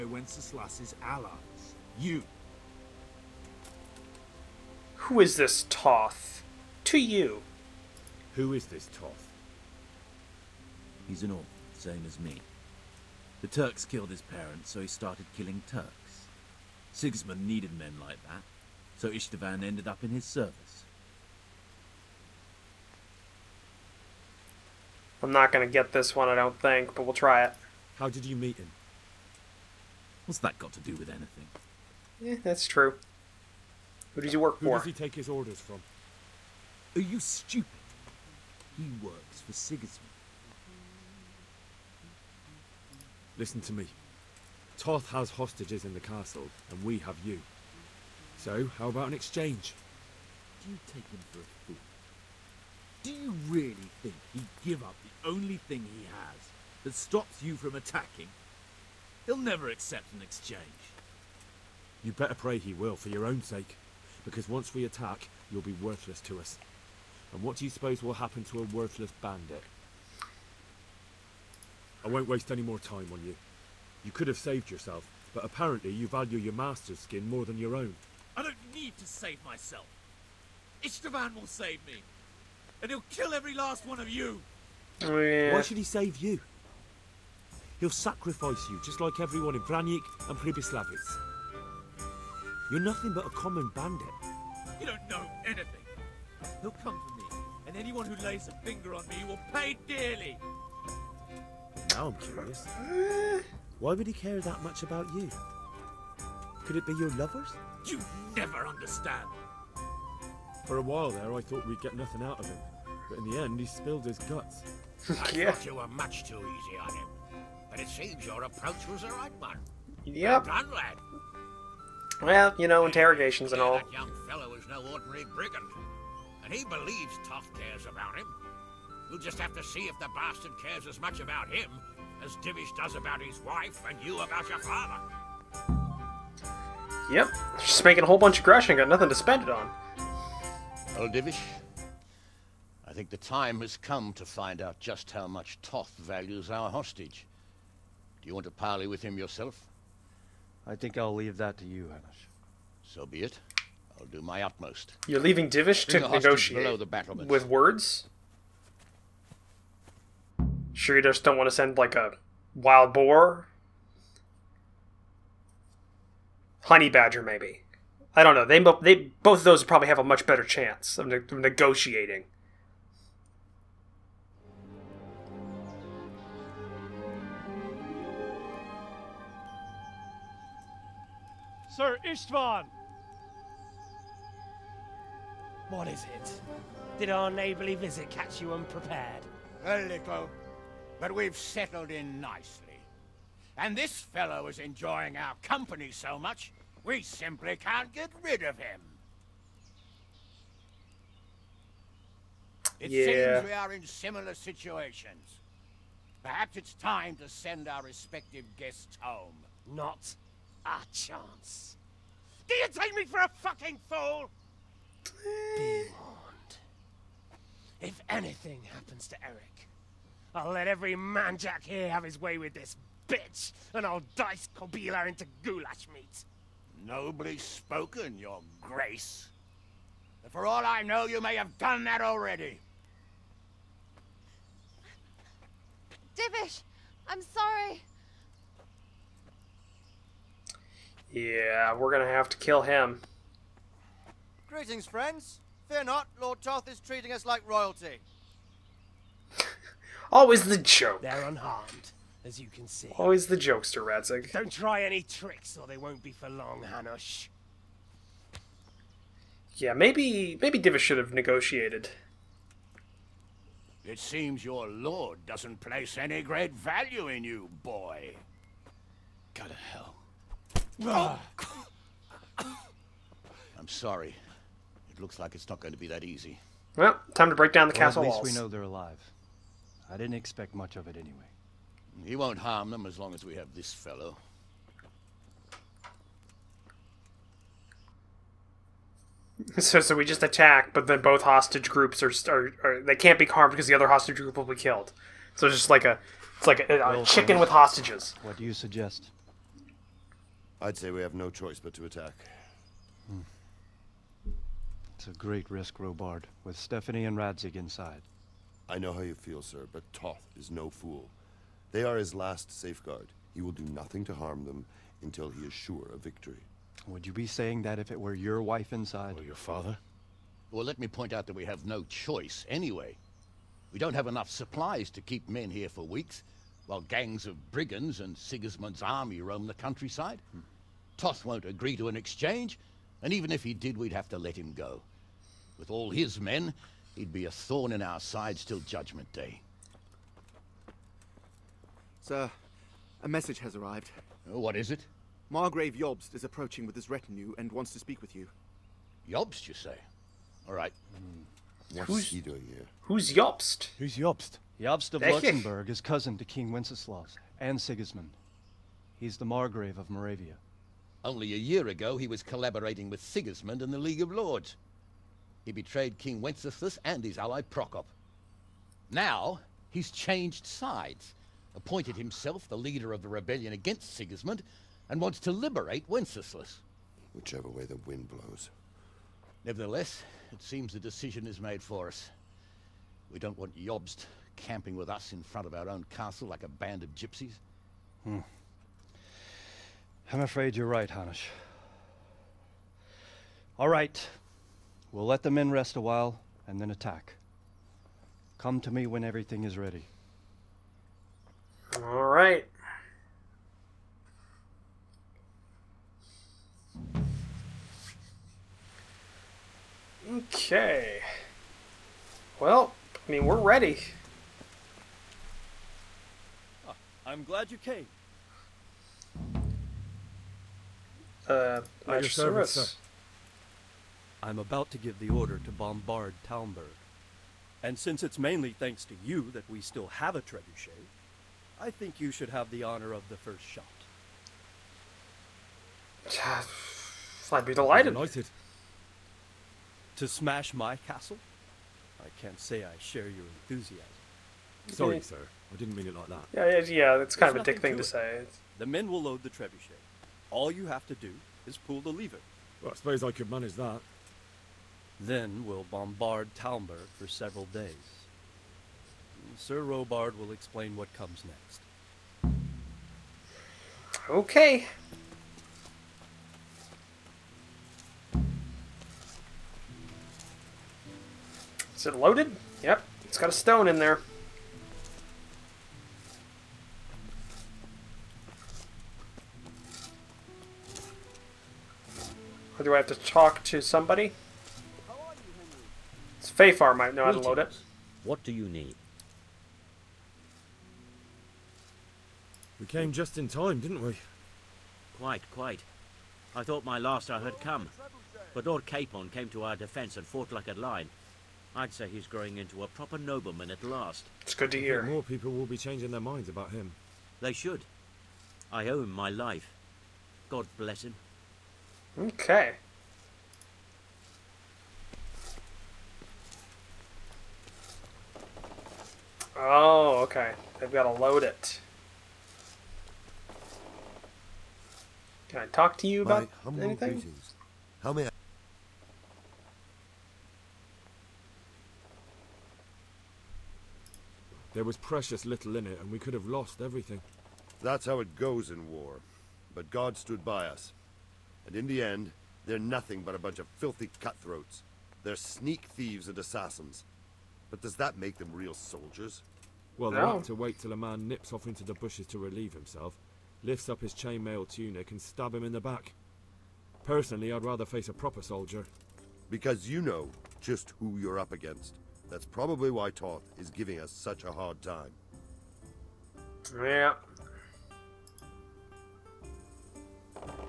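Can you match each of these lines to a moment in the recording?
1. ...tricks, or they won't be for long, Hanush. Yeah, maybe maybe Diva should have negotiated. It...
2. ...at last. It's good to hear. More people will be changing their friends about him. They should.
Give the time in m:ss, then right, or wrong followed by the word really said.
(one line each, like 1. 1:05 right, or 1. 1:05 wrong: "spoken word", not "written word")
1. 4:15 right
2. 8:23 wrong: "minds", not "friends".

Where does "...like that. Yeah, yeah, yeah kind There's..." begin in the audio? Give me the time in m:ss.
7:25.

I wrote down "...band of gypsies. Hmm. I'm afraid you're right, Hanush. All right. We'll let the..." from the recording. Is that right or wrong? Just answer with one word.
right.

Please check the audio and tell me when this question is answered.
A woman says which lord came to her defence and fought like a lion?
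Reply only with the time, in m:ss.
8:18.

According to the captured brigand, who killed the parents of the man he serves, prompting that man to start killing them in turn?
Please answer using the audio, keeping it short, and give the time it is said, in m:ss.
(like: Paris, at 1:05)
The Turks, at 0:13.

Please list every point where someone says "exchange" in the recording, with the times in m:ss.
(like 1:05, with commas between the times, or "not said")
0:49, 1:00, 5:31.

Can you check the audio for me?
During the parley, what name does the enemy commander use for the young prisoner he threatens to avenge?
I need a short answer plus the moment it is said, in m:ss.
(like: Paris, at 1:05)
Eric, at 3:39.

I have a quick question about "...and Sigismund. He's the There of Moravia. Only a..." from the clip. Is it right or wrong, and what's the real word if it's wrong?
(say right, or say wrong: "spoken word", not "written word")
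wrong: "Margrave", not "There".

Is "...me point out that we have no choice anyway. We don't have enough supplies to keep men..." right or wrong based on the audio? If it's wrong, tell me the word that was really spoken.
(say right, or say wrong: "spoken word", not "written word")
right.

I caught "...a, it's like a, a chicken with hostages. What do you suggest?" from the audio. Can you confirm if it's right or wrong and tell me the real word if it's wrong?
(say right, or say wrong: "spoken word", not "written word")
right.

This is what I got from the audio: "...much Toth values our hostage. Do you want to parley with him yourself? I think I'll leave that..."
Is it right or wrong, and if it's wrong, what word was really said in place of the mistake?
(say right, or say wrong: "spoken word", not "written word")
right.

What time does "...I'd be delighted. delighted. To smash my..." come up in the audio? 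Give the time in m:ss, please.
7:17.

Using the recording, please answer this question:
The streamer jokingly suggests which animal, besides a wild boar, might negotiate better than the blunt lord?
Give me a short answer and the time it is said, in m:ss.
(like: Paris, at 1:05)
Honey badger, at 2:46.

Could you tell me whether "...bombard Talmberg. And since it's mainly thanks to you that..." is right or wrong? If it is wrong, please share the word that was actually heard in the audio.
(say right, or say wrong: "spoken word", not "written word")
right.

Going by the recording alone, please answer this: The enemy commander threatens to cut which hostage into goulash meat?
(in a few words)
Kobyla.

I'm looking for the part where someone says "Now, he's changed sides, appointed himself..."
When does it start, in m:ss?
6:08.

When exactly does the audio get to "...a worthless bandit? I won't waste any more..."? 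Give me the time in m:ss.
1:08.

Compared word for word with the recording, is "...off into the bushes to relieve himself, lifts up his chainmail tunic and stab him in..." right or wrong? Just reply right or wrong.
right.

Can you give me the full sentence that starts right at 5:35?
With all his men, he'd be a thorn in our sides till Judgment Day.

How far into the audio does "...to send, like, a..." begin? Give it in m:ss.
2:41.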